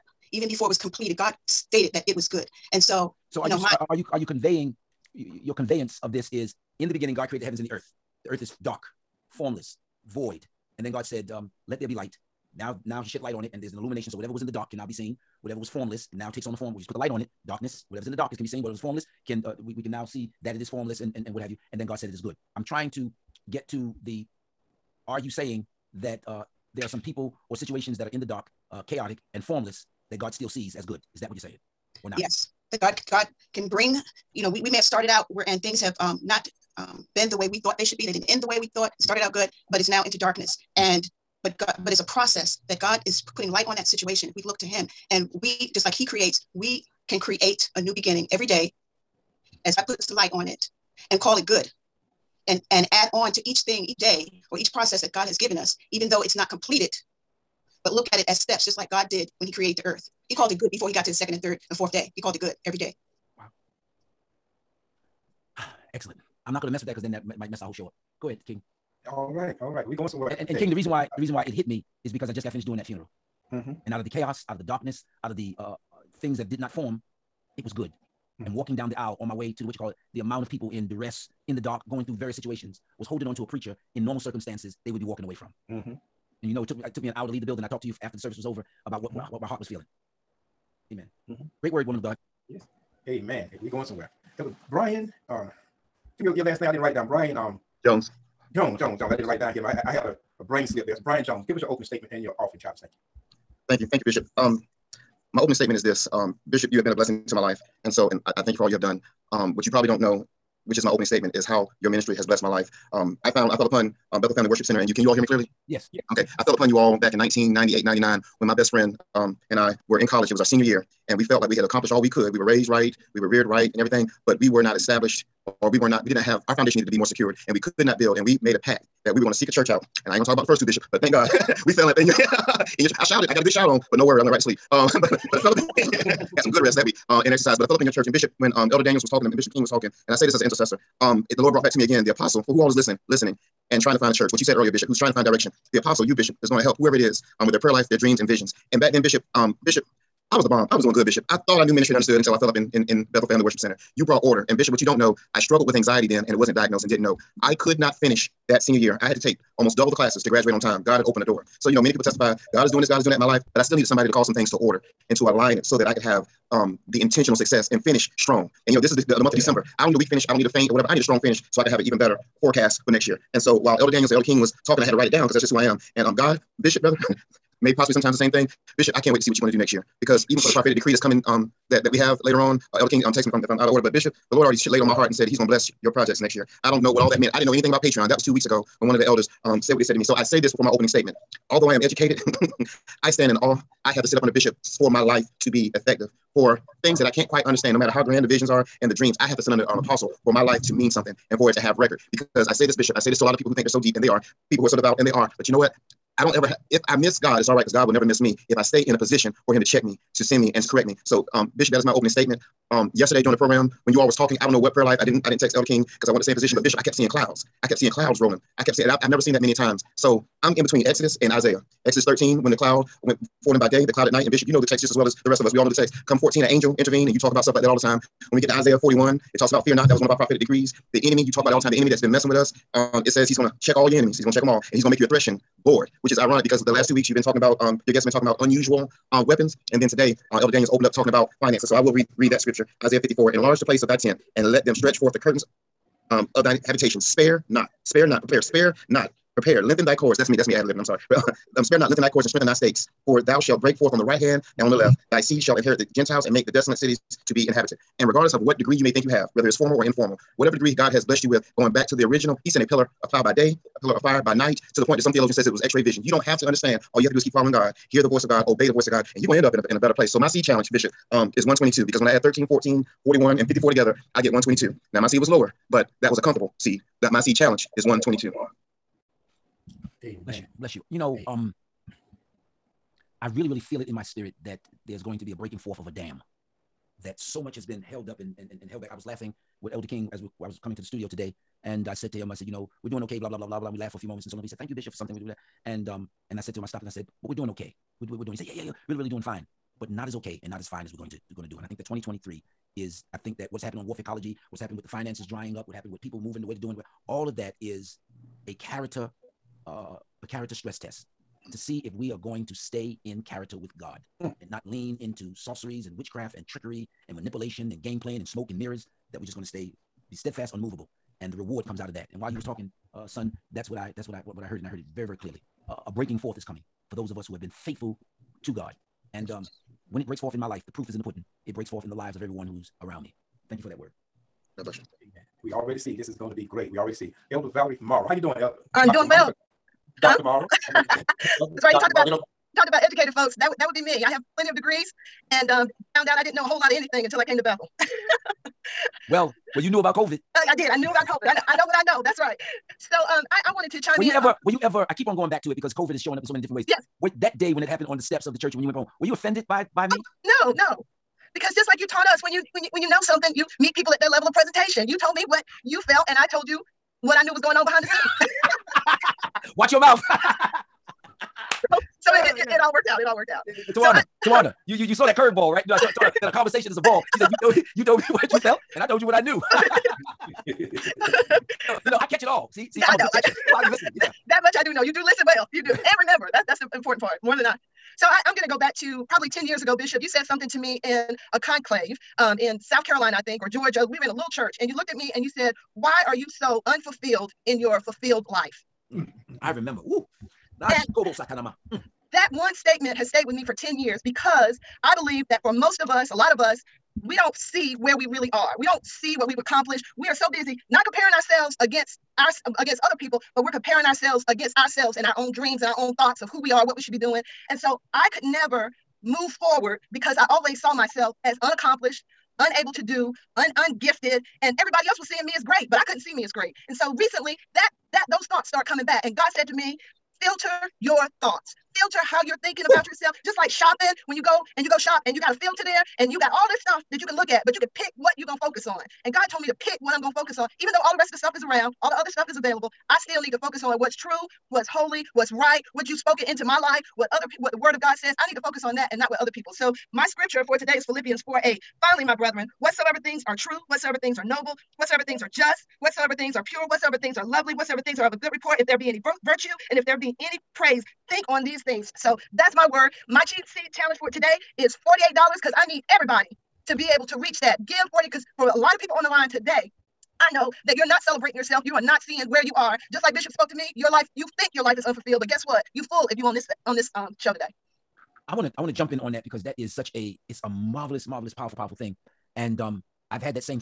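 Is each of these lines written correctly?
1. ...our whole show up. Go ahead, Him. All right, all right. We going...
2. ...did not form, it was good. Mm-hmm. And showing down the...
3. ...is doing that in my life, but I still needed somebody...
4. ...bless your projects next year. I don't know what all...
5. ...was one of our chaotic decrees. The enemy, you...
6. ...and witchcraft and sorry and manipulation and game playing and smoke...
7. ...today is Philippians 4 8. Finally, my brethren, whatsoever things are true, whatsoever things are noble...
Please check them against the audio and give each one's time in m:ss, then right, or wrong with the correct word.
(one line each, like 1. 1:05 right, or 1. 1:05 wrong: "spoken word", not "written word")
1. 1:07 wrong: "King", not "Him"
2. 1:16 wrong: "walking", not "showing"
3. 2:42 right
4. 3:05 right
5. 3:49 wrong: "prophetic", not "chaotic"
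6. 5:15 wrong: "trickery", not "sorry"
7. 7:30 right.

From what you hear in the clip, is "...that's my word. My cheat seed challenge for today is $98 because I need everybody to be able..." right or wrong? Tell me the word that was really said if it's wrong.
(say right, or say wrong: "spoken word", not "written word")
wrong: "48", not "98".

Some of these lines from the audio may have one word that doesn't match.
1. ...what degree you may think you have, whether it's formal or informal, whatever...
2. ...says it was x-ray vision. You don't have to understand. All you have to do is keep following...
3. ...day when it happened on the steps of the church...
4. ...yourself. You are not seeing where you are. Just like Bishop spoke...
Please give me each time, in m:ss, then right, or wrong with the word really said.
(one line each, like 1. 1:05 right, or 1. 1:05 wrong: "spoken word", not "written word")
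1. 4:18 right
2. 4:25 right
3. 5:57 right
4. 7:51 right.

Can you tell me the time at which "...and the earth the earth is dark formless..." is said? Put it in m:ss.
0:07.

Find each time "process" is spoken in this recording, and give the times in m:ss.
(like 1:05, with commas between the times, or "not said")
0:42, 0:54.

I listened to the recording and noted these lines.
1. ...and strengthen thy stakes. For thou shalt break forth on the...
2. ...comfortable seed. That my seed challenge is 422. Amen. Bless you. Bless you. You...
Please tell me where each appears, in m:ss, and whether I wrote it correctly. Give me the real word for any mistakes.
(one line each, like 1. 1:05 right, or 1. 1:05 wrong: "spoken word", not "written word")
1. 4:12 right
2. 4:36 wrong: "122", not "422".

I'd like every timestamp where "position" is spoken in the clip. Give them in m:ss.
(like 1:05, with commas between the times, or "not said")
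3:28, 3:36.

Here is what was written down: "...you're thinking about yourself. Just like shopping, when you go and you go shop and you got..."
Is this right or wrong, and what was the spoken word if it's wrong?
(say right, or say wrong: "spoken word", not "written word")
right.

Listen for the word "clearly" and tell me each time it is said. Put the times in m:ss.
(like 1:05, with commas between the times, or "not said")
1:55, 5:25.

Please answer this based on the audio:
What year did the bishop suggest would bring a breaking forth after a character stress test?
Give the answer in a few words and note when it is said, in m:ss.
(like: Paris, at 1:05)
2023, at 5:01.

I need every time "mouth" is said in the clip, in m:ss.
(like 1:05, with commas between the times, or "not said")
6:09.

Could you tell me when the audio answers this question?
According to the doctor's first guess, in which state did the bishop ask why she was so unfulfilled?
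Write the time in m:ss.
6:32.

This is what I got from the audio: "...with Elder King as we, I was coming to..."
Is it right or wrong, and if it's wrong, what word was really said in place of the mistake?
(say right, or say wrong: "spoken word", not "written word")
right.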